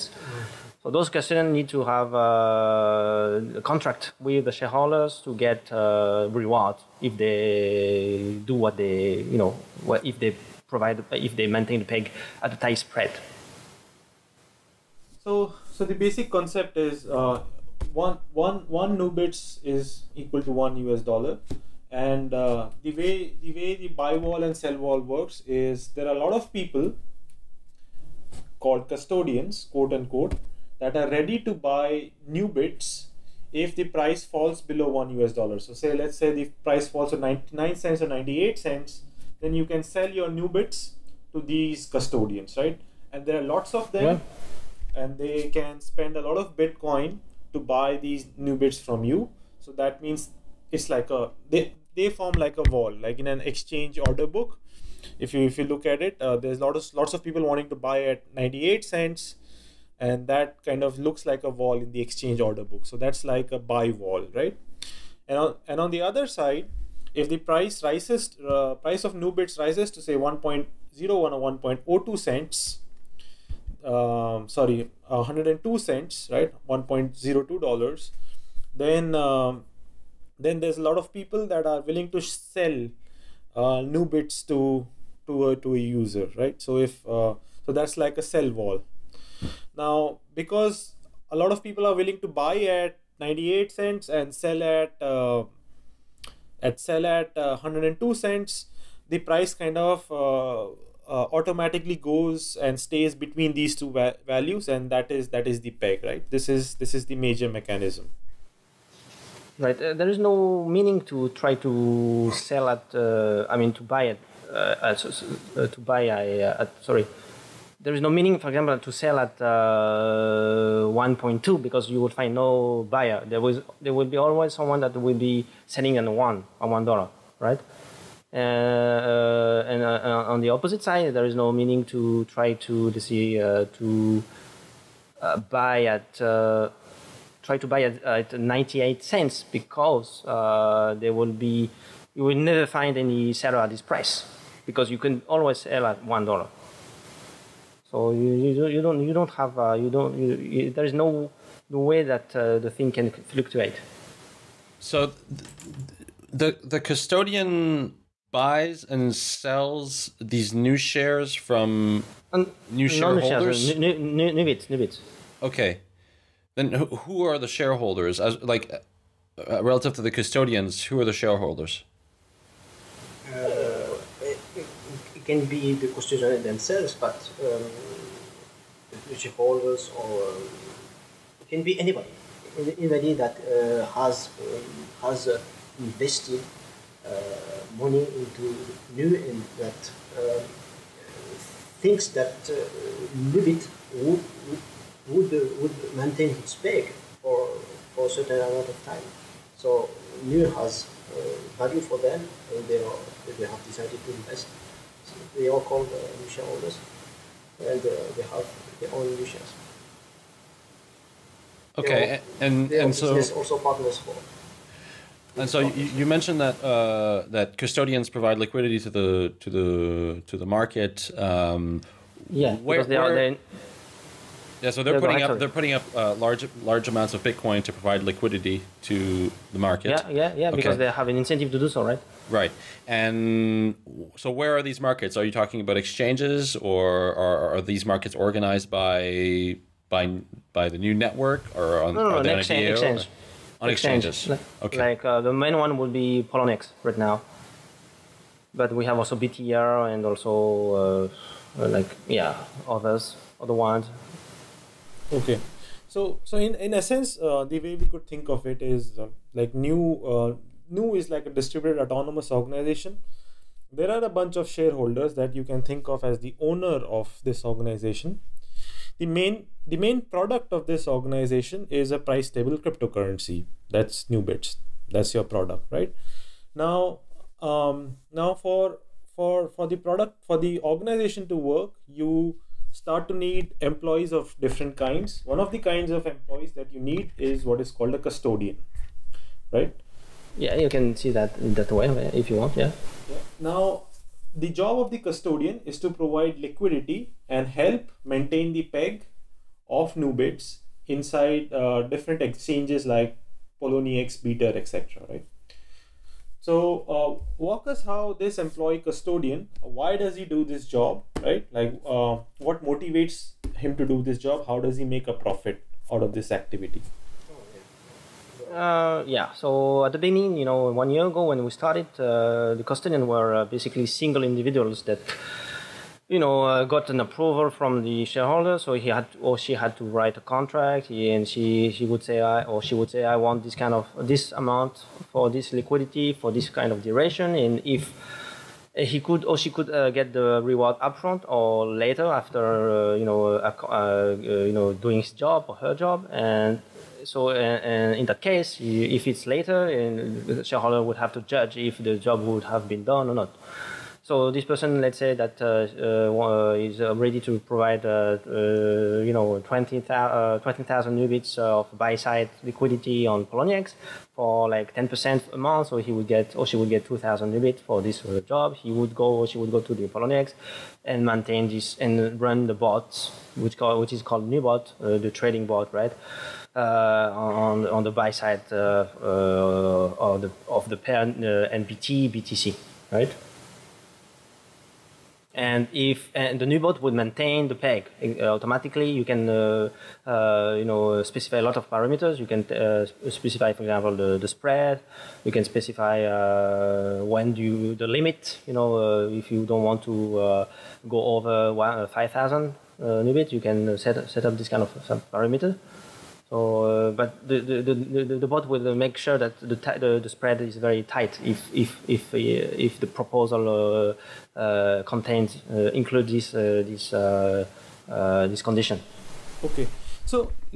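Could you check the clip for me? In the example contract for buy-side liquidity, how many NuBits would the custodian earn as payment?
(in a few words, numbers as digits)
2,000 NuBits.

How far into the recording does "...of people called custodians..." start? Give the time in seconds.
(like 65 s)
26 s.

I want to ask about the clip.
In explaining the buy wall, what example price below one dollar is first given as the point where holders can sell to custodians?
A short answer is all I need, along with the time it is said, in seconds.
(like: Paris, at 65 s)
99 cents, at 37 s.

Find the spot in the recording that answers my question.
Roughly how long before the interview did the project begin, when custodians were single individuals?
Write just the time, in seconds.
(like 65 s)
320 s.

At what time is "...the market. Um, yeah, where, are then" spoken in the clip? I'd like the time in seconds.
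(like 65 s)
220 s.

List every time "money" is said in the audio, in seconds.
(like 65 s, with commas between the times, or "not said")
187 s.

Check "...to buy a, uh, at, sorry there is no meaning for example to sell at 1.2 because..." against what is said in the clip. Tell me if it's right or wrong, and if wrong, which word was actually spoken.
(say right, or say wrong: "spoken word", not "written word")
right.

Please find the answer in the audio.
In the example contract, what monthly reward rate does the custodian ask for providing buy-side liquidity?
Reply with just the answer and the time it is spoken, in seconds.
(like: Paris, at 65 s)
10%, at 364 s.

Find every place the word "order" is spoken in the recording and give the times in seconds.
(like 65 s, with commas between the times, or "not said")
54 s, 62 s.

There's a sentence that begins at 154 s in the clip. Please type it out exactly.
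So the the custodian buys and sells these NuShares from um, new shareholders?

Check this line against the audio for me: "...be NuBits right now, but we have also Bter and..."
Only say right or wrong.
wrong.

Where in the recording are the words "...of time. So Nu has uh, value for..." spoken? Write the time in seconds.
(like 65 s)
198 s.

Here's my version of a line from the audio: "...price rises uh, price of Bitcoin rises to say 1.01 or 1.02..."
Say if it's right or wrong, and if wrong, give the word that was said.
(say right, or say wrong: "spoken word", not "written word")
wrong: "NuBits", not "Bitcoin".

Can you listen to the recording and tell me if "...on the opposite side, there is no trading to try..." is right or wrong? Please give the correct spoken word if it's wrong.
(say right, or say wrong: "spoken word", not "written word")
wrong: "meaning", not "trading".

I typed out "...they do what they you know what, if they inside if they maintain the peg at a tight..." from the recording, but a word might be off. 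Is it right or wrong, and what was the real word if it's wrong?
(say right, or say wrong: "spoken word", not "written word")
wrong: "provide", not "inside".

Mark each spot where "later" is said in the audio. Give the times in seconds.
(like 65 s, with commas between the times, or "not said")
341 s, 349 s.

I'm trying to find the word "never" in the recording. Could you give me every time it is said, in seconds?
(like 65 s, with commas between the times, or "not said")
142 s.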